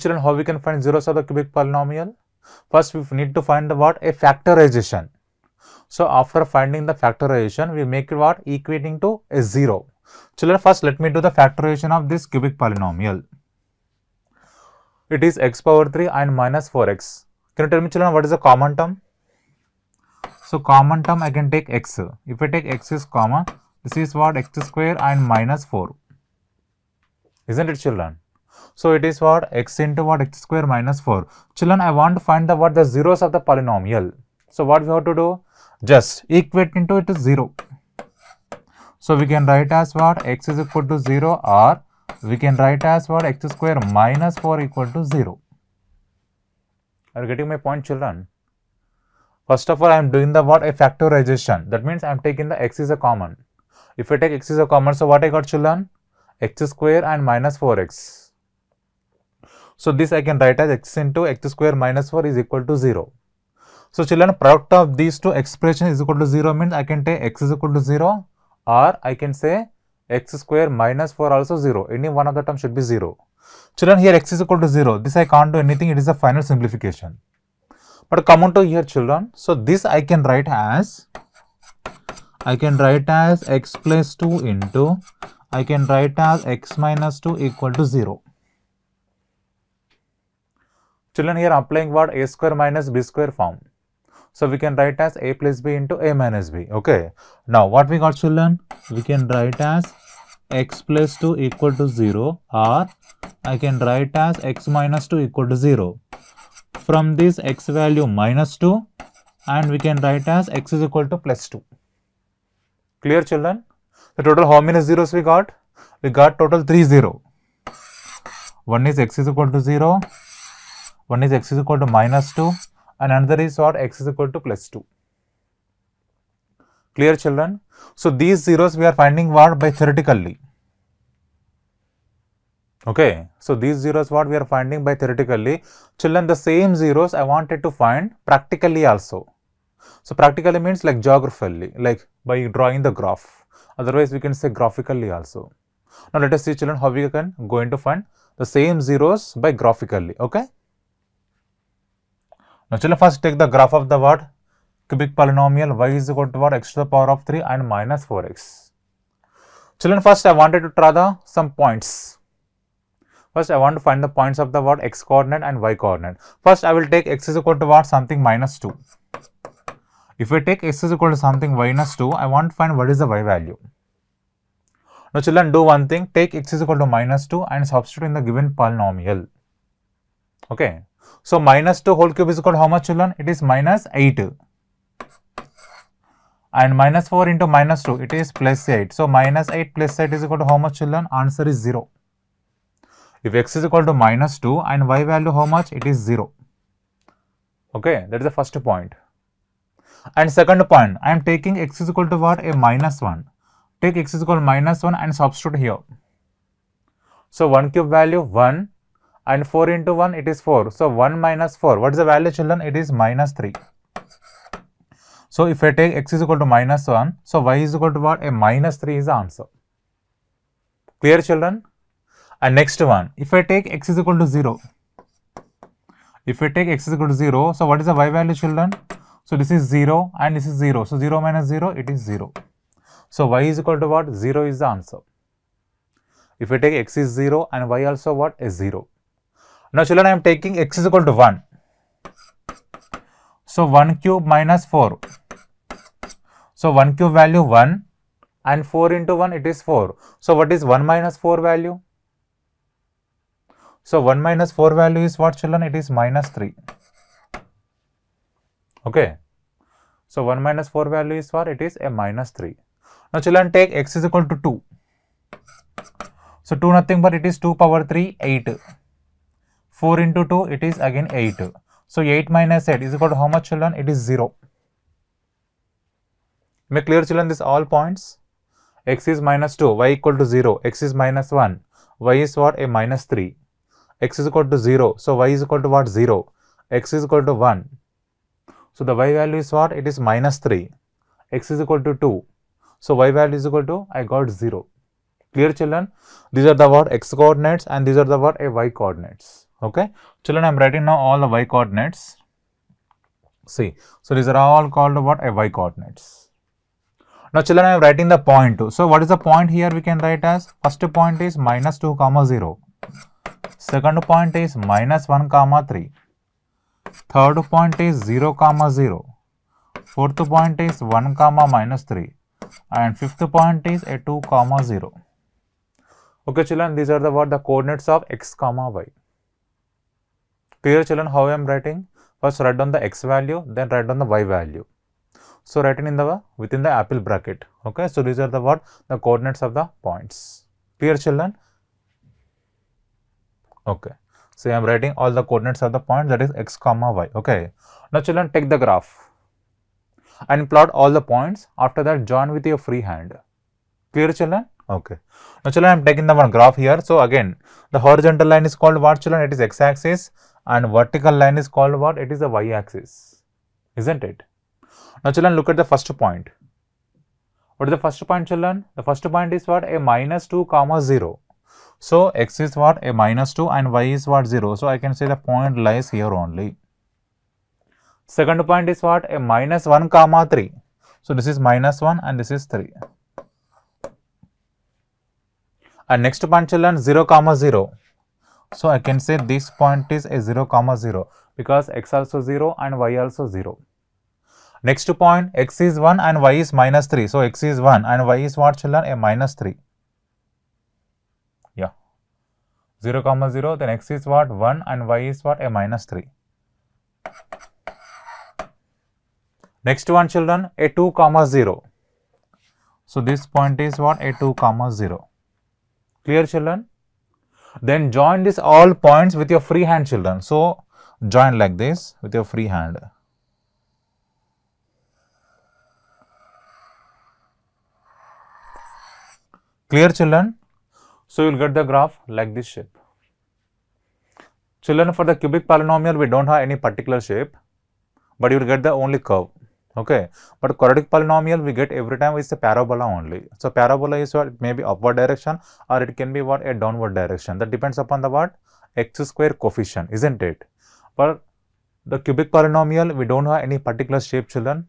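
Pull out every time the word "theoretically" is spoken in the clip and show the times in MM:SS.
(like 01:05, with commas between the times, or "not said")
02:09, 02:14.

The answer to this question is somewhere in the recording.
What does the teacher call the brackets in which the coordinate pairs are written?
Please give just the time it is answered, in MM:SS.
05:36.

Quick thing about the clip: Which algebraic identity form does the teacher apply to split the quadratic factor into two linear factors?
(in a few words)
a square minus b square.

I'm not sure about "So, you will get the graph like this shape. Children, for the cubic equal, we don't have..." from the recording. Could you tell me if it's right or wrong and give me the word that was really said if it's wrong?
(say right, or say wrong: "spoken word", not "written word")
wrong: "polynomial", not "equal".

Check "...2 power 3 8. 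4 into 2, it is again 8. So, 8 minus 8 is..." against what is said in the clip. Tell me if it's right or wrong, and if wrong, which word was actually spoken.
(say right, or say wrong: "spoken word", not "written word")
right.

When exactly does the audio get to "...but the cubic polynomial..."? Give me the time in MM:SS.
07:31.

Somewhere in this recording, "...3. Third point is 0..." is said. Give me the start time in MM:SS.
05:15.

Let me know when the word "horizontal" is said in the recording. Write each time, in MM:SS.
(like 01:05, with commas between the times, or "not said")
05:57.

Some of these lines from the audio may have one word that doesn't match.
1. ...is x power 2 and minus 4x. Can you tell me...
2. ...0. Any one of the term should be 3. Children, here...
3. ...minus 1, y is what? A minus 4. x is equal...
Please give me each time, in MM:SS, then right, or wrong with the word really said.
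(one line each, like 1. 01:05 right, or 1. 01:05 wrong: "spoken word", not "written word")
1. 00:15 wrong: "3", not "2"
2. 01:11 wrong: "0", not "3"
3. 04:40 wrong: "3", not "4".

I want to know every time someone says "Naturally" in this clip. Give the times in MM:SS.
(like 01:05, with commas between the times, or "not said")
05:55.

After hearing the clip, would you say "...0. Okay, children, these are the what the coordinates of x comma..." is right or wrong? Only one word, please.
right.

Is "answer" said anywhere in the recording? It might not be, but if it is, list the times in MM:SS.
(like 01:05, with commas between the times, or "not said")
03:11, 03:39, 03:54.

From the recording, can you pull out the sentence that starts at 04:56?
x coordinates and these are the what?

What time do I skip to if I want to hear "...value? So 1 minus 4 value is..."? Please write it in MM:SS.
04:11.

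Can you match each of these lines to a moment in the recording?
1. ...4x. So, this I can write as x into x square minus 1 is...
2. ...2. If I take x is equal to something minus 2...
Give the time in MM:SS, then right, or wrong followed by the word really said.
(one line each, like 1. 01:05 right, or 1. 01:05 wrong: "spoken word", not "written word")
1. 00:57 wrong: "4", not "1"
2. 02:48 right.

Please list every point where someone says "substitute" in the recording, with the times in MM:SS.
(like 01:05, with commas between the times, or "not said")
02:57, 03:25.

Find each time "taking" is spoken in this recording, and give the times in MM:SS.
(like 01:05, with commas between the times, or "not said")
00:52, 03:21, 04:00, 05:55.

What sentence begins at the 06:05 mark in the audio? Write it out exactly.
Now, children look at the first point.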